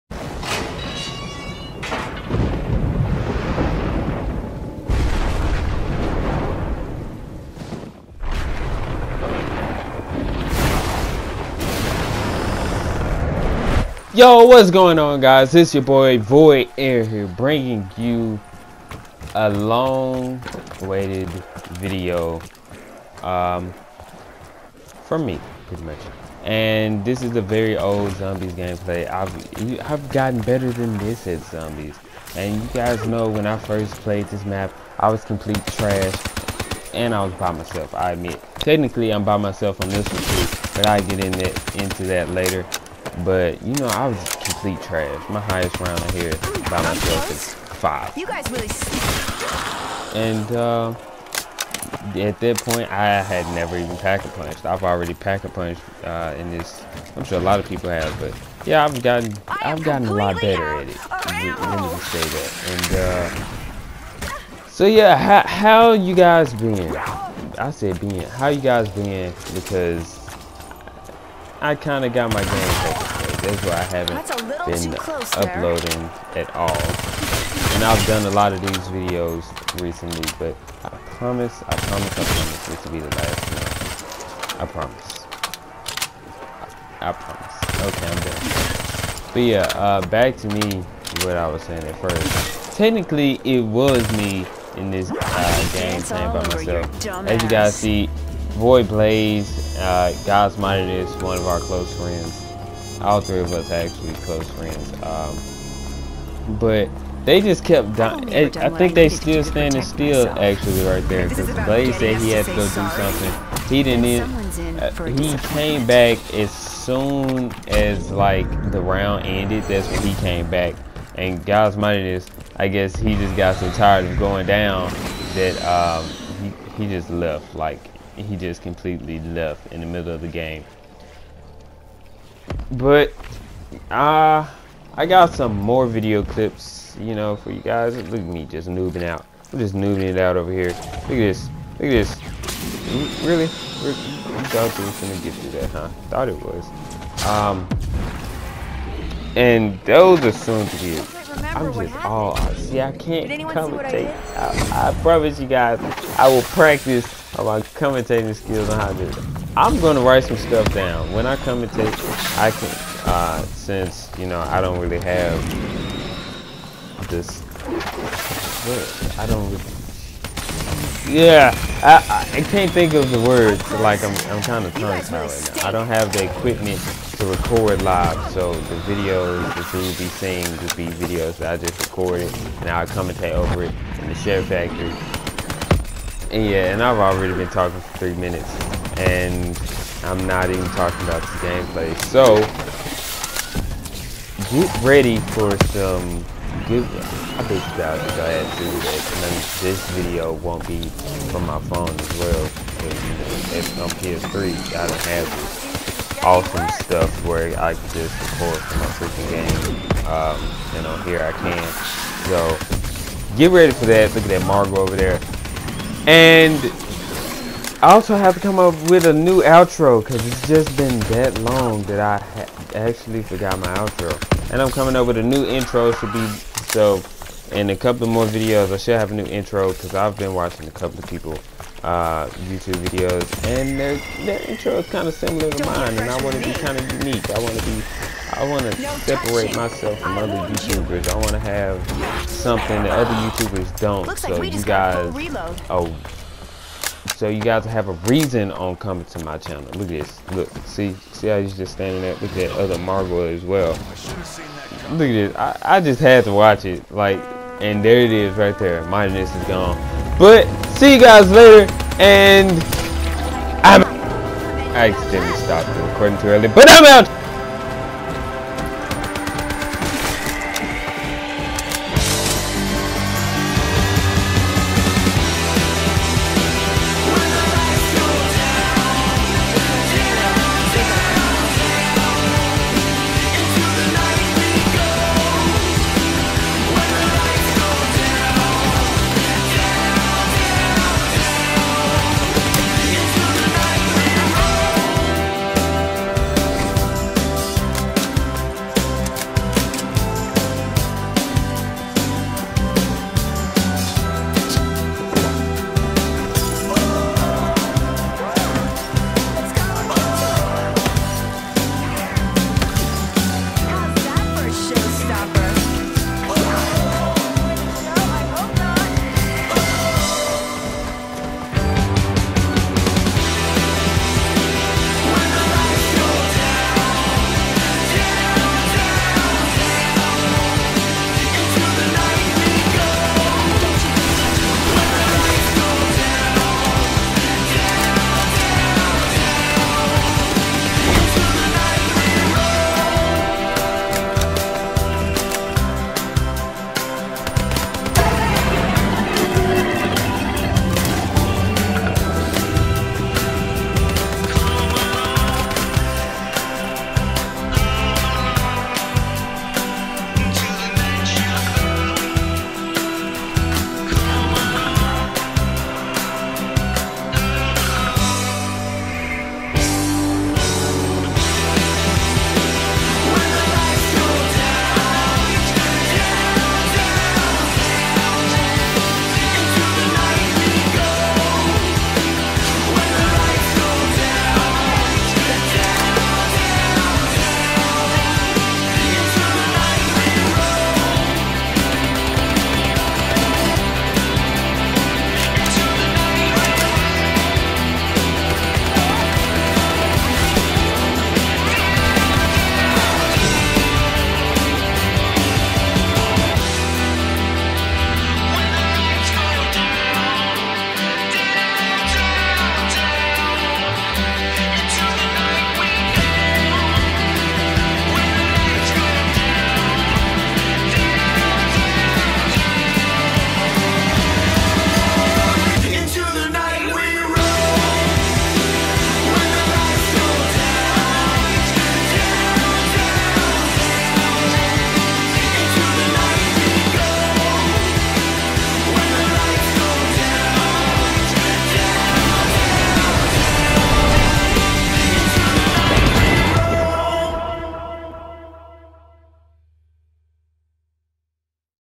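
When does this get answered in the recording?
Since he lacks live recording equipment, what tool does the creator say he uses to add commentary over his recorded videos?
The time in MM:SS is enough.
03:04.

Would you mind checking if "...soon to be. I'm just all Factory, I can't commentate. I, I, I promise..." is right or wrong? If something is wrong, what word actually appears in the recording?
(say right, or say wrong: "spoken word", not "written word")
wrong: "See", not "Factory".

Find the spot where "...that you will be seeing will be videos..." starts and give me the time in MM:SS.
02:59.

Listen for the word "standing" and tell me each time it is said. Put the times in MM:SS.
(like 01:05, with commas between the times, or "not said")
01:49, 04:11.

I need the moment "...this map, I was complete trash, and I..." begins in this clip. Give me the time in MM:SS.
00:34.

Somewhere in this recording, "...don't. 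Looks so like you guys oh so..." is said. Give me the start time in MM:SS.
04:03.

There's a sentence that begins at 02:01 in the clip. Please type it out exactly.
And God's mightiness, I guess he just got so tired of going down that um, he, he just left.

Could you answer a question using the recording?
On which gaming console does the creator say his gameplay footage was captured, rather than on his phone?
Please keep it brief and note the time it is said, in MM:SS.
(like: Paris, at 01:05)
PS3, at 03:24.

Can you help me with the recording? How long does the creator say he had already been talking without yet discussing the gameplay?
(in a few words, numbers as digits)
3 minutes.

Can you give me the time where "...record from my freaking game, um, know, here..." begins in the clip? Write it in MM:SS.
03:28.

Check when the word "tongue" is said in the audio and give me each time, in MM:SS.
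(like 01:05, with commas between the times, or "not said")
02:54.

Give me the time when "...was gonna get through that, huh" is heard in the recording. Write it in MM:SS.
02:24.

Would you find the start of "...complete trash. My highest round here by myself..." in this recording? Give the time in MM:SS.
00:44.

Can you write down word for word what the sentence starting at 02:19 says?
I'm just noobing it out over here.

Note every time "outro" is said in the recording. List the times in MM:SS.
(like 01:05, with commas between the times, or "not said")
03:39, 03:43.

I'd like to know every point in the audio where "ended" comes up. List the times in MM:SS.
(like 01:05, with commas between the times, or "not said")
01:59.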